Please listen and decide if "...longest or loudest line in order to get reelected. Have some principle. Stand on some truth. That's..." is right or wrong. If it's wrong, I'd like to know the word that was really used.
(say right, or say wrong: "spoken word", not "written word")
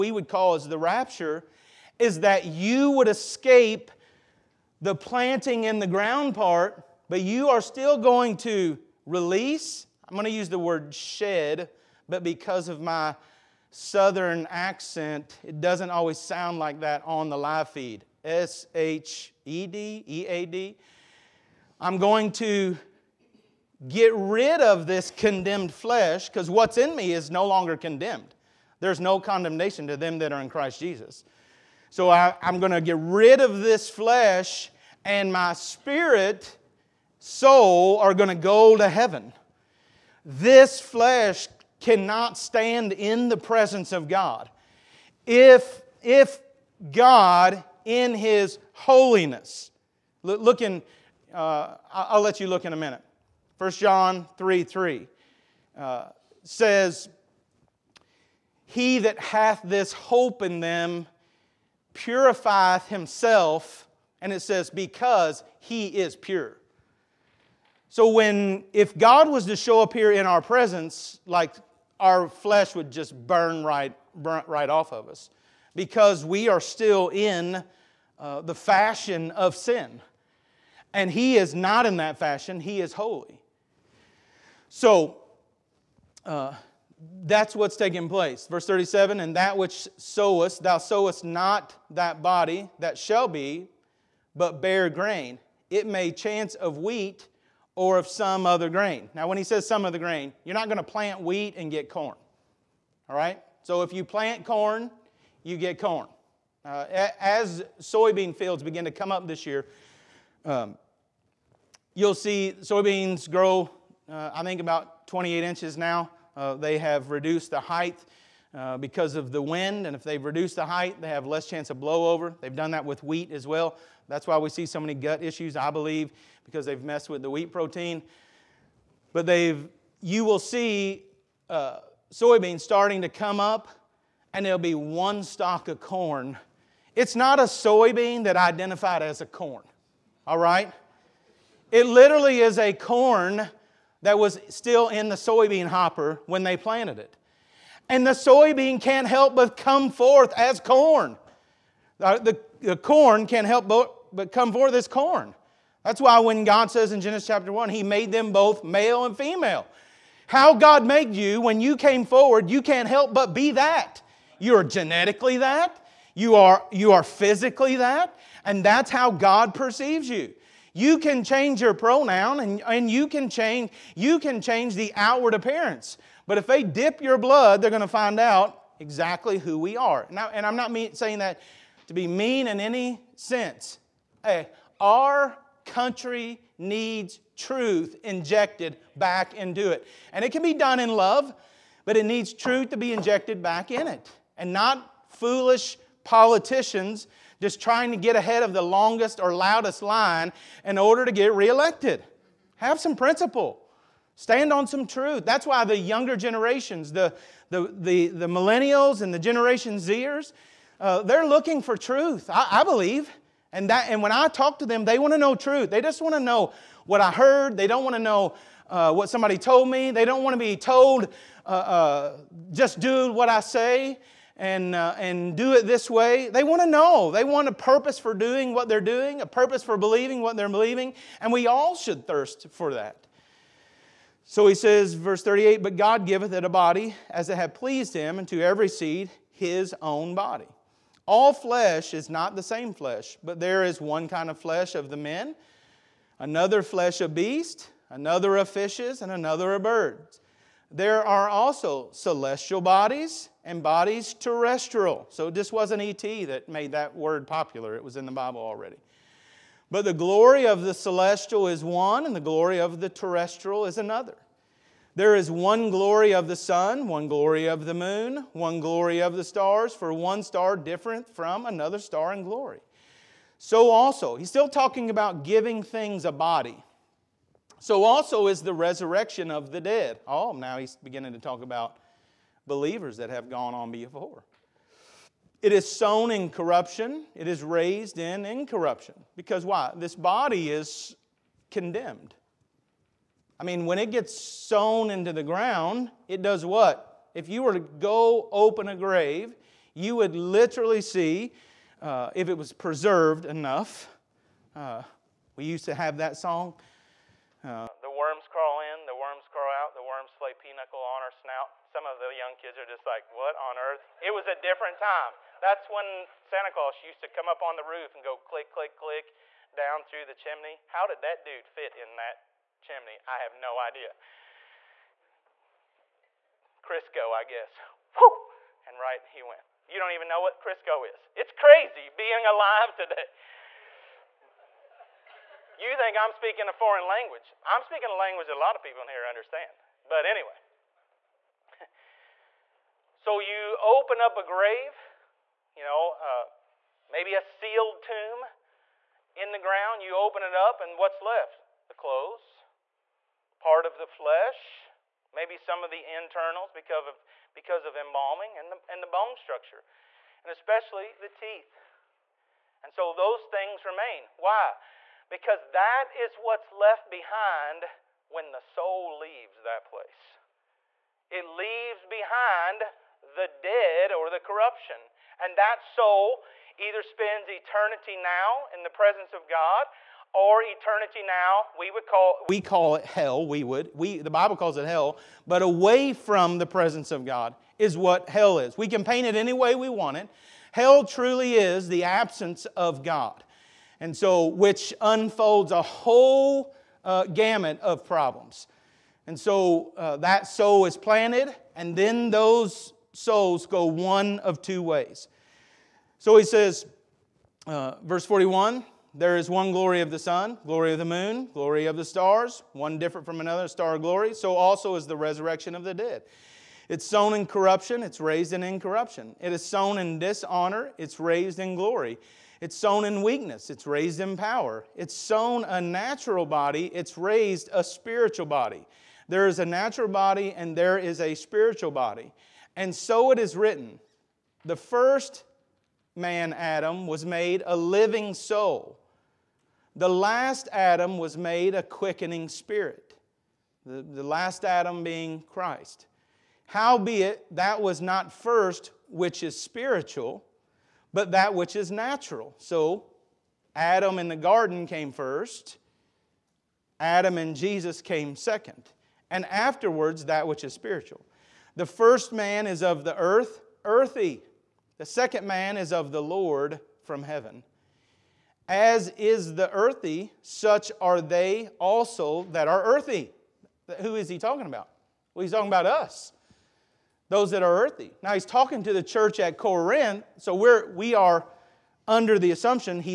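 right.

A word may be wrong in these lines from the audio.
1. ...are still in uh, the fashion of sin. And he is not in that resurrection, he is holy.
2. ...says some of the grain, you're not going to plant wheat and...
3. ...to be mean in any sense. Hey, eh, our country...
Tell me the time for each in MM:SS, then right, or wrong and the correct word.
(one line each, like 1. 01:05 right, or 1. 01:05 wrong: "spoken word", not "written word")
1. 01:16 wrong: "fashion", not "resurrection"
2. 01:39 right
3. 03:01 right.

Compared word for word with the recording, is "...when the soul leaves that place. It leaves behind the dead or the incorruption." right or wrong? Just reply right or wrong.
wrong.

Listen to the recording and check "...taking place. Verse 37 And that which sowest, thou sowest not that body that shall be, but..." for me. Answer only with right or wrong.
right.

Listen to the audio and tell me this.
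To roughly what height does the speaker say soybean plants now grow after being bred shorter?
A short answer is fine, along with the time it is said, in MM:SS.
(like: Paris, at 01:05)
28 inches, at 01:55.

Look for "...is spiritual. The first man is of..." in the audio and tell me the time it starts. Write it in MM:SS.
07:40.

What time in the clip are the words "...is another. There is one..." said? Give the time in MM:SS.
04:23.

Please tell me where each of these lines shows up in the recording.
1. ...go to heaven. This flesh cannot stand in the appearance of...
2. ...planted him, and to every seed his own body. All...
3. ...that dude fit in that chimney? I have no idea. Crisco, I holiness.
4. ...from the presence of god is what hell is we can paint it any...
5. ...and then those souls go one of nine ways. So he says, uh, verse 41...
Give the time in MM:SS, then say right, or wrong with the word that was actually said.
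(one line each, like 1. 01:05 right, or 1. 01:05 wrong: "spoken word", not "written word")
1. 00:38 wrong: "presence", not "appearance"
2. 03:57 wrong: "pleased", not "planted"
3. 05:21 wrong: "guess", not "holiness"
4. 06:25 right
5. 06:41 wrong: "two", not "nine".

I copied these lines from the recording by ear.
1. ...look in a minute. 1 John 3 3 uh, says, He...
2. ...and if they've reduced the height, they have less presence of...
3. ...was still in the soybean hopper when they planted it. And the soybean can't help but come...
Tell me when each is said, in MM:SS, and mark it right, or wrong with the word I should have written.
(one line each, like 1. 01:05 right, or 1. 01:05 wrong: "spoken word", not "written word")
1. 00:52 right
2. 01:59 wrong: "chance", not "presence"
3. 02:24 right.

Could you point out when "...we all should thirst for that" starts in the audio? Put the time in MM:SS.
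03:51.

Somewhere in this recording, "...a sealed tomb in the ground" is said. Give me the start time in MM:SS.
05:47.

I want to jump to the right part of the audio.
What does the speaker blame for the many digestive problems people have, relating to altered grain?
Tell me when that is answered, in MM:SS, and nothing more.
02:07.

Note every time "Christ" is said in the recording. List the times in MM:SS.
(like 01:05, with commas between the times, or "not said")
00:30, 07:25.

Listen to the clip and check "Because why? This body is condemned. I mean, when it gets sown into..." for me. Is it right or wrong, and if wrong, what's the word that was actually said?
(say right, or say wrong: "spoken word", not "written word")
right.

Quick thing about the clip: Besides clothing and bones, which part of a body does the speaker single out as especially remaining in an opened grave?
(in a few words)
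The teeth.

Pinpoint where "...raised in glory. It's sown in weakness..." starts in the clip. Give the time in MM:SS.
07:00.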